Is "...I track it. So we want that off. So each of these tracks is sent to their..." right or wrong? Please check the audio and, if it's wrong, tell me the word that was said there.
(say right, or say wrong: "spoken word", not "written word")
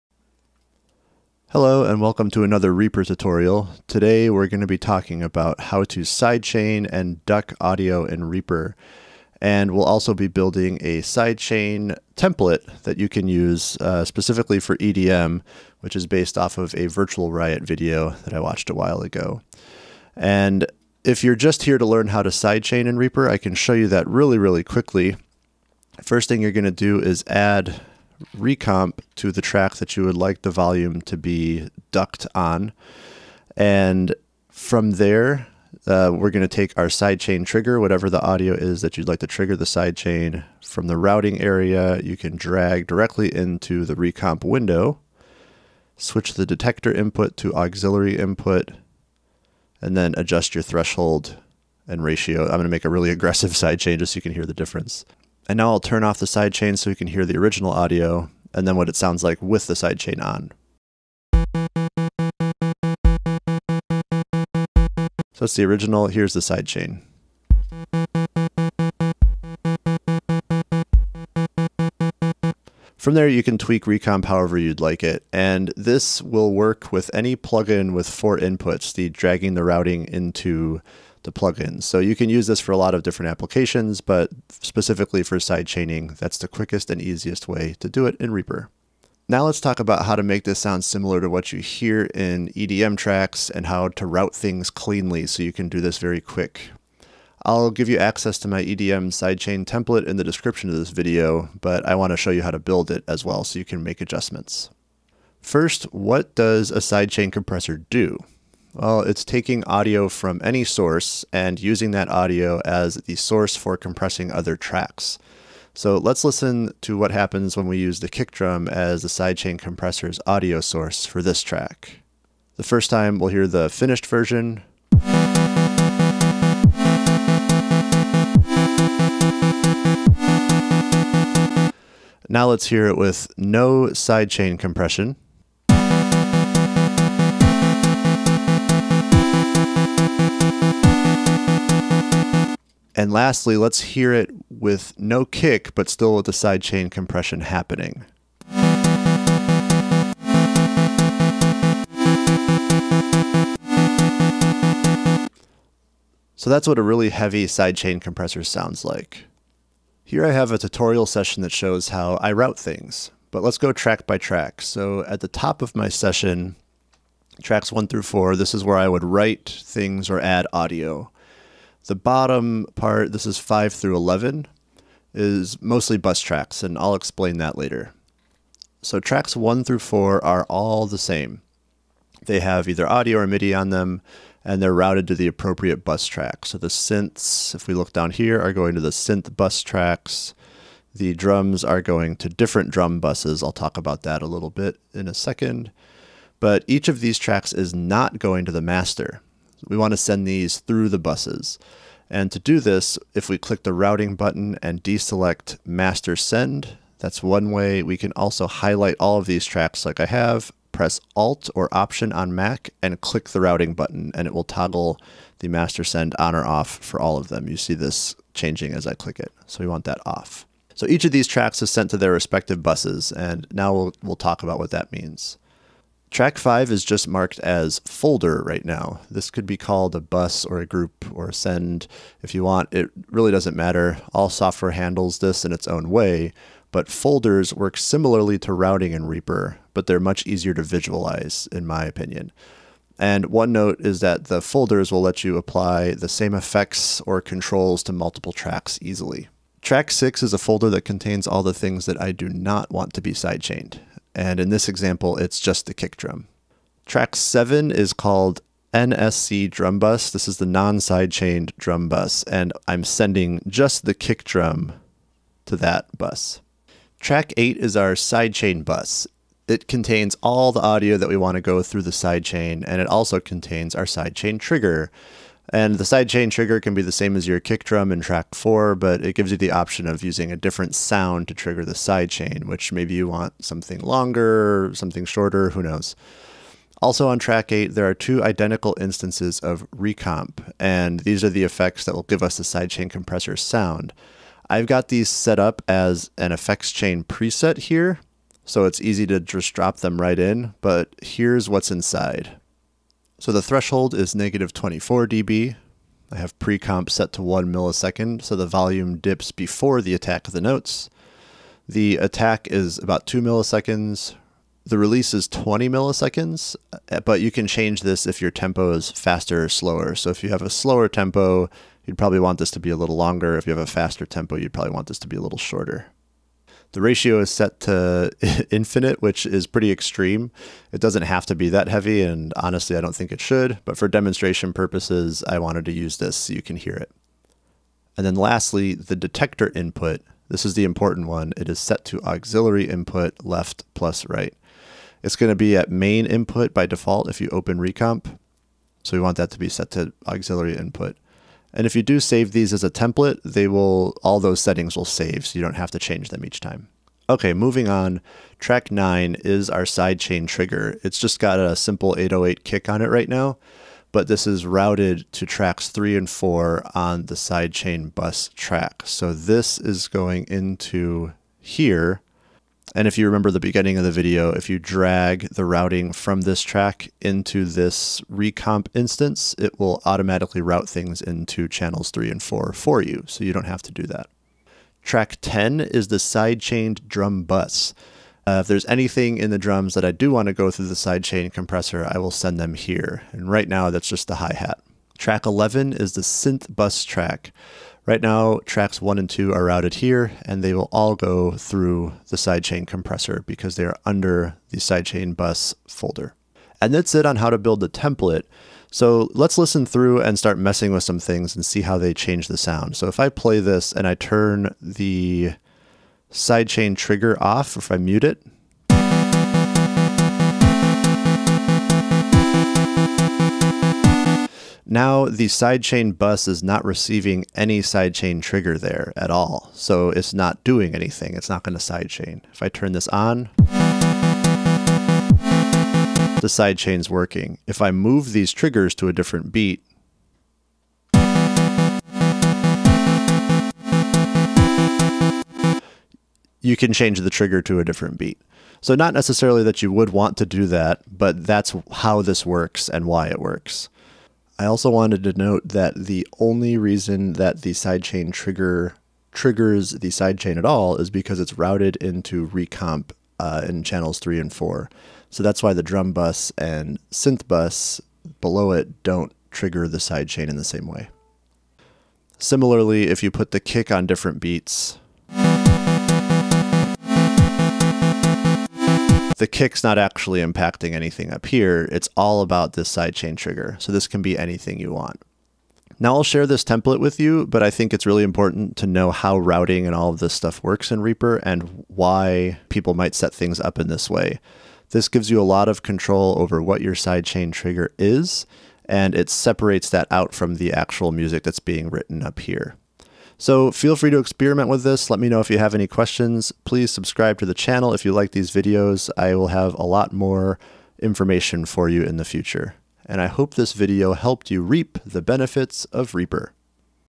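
wrong: "click", not "track".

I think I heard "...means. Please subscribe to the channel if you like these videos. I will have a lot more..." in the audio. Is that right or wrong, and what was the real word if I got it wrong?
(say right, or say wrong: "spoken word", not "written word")
wrong: "questions", not "means".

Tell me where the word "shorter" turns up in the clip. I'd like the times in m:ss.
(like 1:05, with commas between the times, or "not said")
4:45, 5:25.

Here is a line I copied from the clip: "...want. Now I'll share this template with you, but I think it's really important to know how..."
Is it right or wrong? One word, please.
right.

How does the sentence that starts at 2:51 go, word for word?
The bottom part, this is 5 through 11, is mostly bus tracks, and I'll explain that later.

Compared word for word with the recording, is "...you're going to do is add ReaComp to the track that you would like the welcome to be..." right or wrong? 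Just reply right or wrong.
wrong.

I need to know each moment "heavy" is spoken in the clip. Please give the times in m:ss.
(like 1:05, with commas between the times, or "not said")
2:37, 5:31.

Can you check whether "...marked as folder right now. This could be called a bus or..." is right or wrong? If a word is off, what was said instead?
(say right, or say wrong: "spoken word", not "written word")
right.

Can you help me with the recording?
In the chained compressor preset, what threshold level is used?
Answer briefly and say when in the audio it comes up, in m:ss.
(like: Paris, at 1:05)
-24 dB, at 5:04.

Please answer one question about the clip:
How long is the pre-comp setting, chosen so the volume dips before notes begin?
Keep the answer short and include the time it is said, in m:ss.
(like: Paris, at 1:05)
1 millisecond, at 5:07.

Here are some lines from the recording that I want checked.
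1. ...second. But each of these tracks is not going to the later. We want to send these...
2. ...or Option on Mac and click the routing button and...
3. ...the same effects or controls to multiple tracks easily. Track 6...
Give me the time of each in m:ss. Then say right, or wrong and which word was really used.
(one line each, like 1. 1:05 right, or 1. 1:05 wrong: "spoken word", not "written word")
1. 3:15 wrong: "master", not "later"
2. 3:31 right
3. 4:05 right.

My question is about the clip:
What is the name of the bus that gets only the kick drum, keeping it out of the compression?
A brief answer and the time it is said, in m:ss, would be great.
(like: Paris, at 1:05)
NSC drum bus, at 4:18.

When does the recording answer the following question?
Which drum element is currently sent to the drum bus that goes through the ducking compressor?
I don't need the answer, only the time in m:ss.
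6:34.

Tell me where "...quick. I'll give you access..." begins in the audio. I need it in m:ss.
1:36.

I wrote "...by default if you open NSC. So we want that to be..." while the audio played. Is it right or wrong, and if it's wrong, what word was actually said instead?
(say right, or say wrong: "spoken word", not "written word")
wrong: "ReaComp", not "NSC".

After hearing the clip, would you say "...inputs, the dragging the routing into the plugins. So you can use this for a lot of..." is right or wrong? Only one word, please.
right.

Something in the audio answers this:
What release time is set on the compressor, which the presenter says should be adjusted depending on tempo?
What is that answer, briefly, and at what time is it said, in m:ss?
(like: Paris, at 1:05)
20 milliseconds, at 5:15.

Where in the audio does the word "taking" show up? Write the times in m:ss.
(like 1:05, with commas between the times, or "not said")
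1:49.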